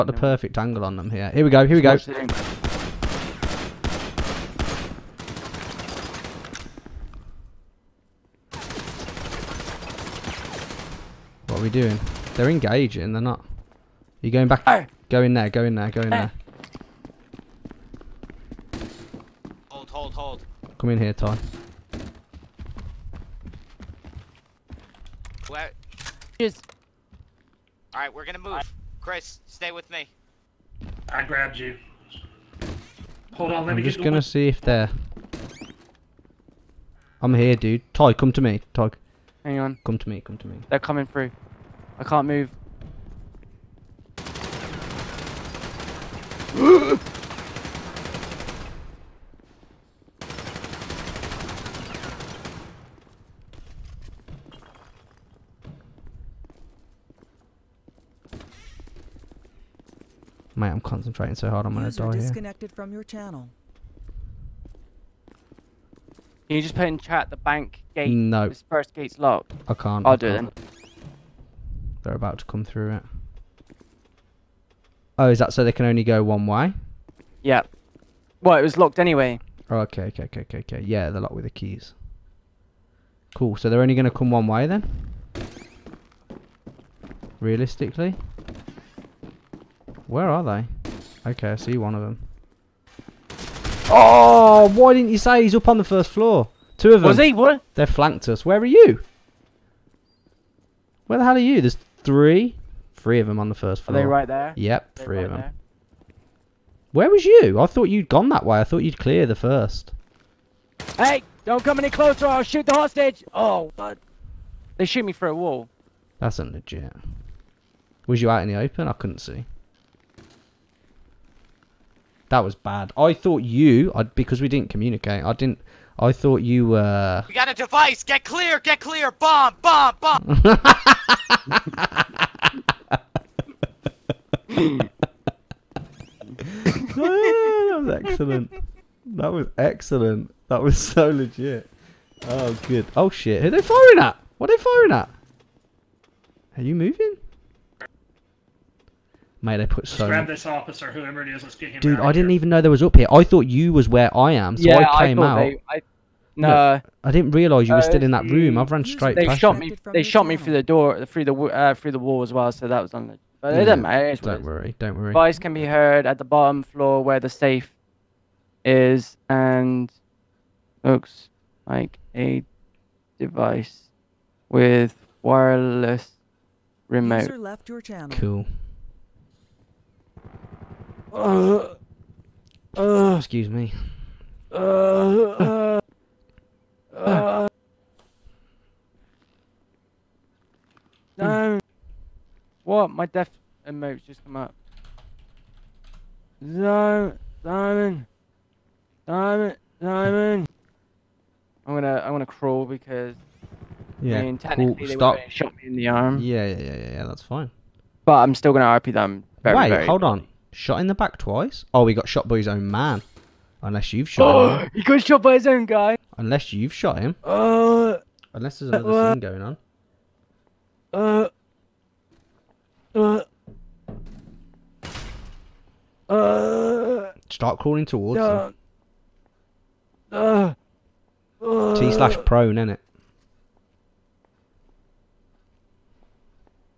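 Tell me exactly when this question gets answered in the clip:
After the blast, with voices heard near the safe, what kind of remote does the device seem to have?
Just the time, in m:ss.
2:55.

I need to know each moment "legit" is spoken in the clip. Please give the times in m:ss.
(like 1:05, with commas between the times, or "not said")
1:56, 2:21.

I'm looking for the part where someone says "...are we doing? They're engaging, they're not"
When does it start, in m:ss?
0:11.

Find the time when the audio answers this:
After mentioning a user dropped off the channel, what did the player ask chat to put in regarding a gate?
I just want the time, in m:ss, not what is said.
1:07.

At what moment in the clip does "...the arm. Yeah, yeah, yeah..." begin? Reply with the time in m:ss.
3:25.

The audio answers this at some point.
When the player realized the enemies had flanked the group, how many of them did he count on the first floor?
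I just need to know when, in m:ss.
1:42.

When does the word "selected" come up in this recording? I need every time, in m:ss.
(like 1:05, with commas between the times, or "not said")
not said.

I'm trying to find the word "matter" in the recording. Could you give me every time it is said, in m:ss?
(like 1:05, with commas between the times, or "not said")
2:43.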